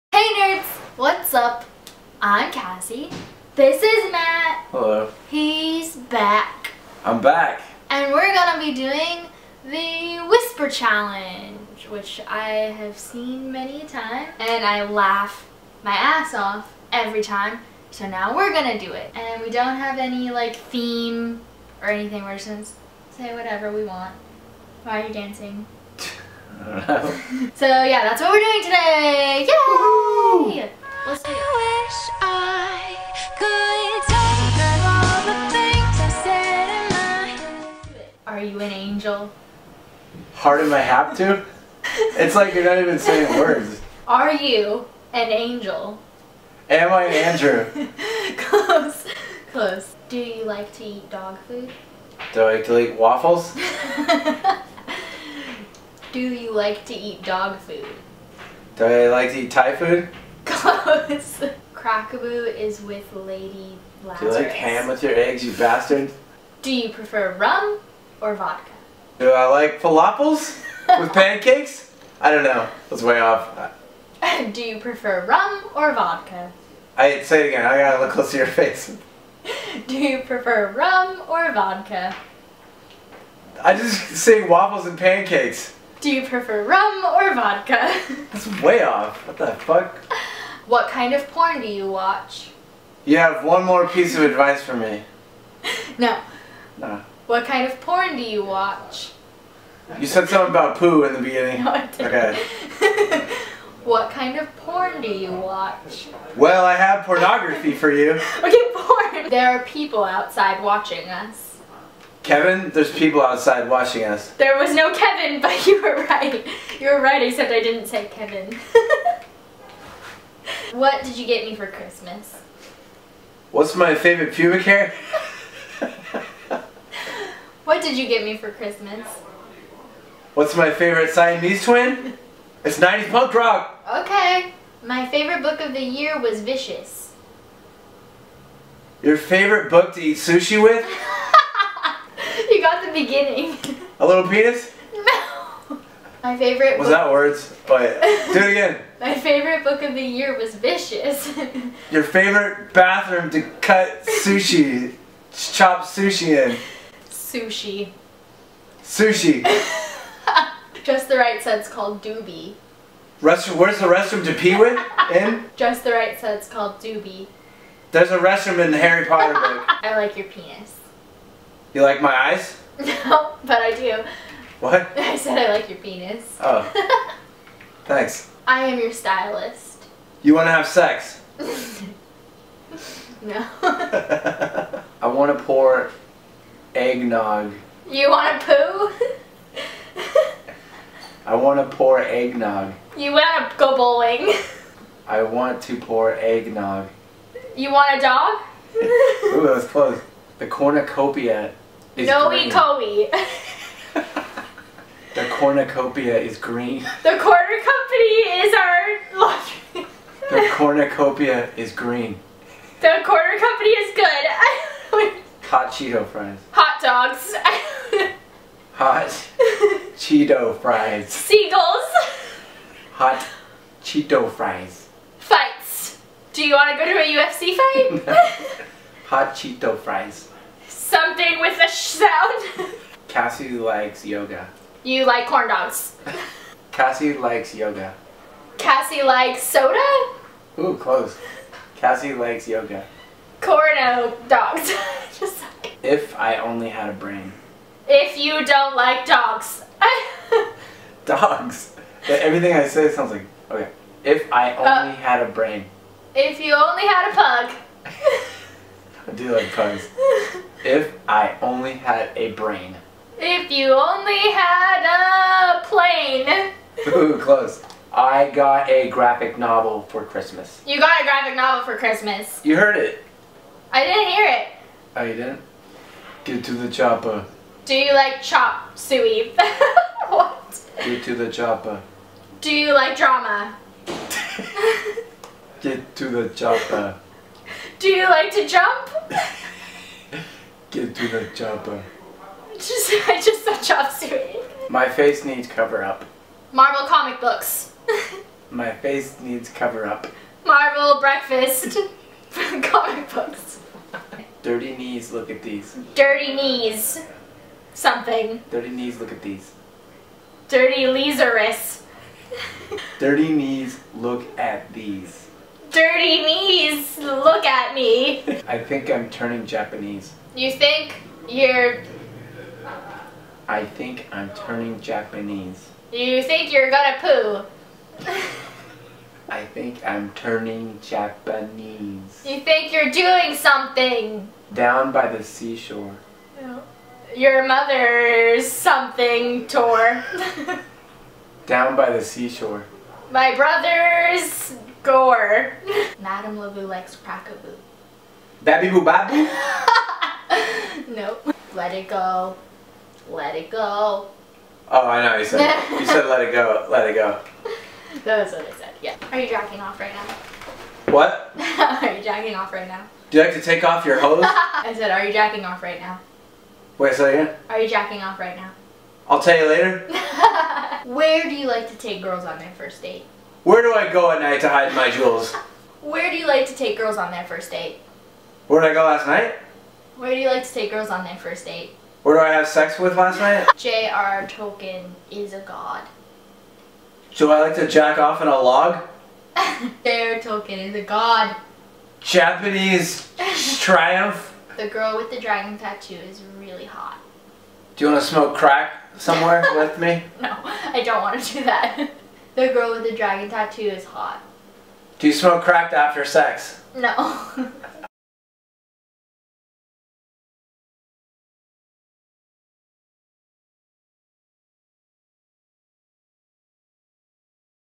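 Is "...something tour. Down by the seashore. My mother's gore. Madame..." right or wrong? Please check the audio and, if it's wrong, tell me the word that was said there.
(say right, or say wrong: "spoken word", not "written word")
wrong: "brother", not "mother".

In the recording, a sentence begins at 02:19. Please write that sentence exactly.
Your favorite book to eat sushi with?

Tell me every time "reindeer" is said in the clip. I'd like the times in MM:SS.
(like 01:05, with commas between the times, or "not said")
not said.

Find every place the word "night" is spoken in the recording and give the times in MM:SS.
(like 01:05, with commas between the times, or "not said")
06:14, 06:19, 06:23.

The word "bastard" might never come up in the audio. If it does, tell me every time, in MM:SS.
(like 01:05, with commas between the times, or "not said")
01:05.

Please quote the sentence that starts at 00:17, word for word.
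So now we're gonna do it.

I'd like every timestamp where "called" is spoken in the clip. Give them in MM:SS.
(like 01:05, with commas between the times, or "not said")
02:41, 02:46.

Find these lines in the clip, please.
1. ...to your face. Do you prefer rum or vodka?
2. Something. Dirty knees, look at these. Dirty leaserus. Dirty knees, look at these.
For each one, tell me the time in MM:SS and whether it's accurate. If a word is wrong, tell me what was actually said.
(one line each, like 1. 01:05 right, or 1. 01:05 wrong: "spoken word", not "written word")
1. 01:18 right
2. 05:07 right.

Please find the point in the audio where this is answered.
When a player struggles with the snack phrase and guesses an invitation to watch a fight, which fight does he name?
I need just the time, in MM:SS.
03:47.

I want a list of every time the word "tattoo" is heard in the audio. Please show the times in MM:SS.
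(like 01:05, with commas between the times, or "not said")
06:35, 06:43.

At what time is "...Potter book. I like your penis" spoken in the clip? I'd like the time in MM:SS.
02:49.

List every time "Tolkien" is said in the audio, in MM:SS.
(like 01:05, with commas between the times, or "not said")
06:24, 06:30.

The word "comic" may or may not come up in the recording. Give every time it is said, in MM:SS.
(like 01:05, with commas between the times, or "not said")
04:56, 05:02.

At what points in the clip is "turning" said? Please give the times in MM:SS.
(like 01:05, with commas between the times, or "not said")
05:19, 05:24, 05:30.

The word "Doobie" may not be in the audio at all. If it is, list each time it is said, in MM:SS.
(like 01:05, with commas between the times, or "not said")
02:42, 02:46.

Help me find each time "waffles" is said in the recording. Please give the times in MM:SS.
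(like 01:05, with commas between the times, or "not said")
00:52, 01:24.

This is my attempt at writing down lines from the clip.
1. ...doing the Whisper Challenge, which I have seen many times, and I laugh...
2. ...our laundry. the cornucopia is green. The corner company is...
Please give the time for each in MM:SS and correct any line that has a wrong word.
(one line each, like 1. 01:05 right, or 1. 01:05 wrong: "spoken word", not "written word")
1. 00:08 right
2. 03:28 right.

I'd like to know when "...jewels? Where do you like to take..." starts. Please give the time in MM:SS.
06:14.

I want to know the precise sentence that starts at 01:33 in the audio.
You have one more piece of advice for me.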